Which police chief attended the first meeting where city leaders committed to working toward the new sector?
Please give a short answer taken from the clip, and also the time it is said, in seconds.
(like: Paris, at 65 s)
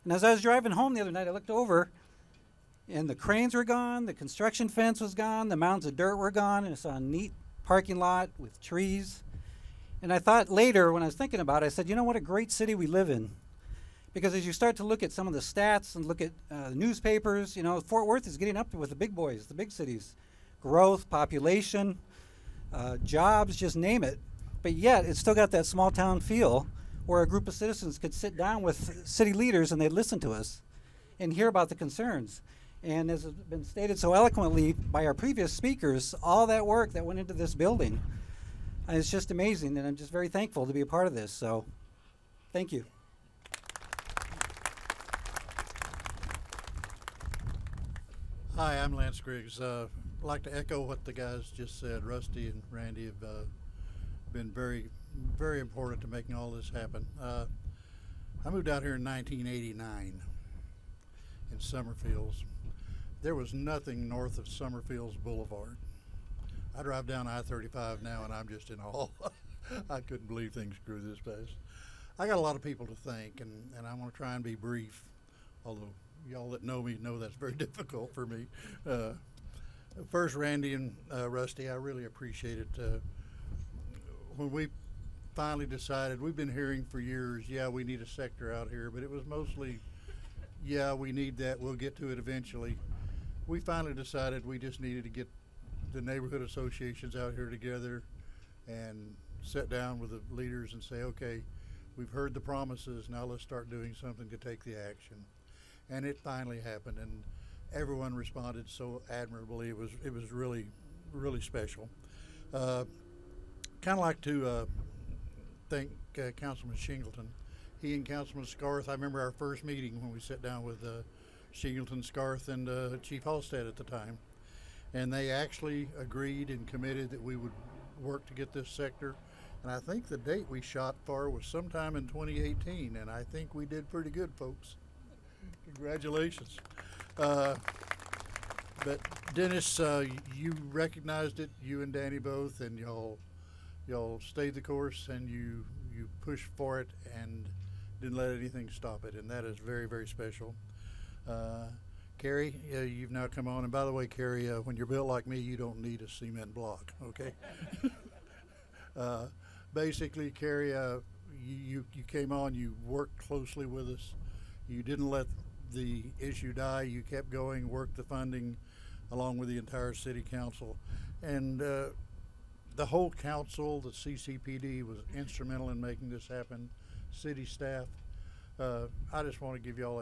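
Chief Halstead, at 123 s.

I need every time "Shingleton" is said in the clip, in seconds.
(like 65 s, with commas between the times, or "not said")
116 s, 121 s.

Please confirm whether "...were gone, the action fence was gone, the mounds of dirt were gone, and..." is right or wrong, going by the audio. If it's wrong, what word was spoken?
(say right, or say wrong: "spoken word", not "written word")
wrong: "construction", not "action".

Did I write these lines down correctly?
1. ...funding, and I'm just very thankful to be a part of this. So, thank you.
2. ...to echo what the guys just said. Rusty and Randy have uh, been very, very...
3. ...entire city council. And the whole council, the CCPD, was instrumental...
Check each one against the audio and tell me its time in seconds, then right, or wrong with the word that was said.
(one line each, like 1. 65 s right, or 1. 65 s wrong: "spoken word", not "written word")
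1. 39 s wrong: "amazing", not "funding"
2. 50 s right
3. 169 s right.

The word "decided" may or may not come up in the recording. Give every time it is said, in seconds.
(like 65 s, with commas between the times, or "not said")
85 s, 93 s.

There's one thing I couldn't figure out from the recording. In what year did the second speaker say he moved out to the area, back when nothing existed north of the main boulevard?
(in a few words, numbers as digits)
1989.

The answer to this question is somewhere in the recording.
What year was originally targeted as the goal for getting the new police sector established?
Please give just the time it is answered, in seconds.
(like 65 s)
132 s.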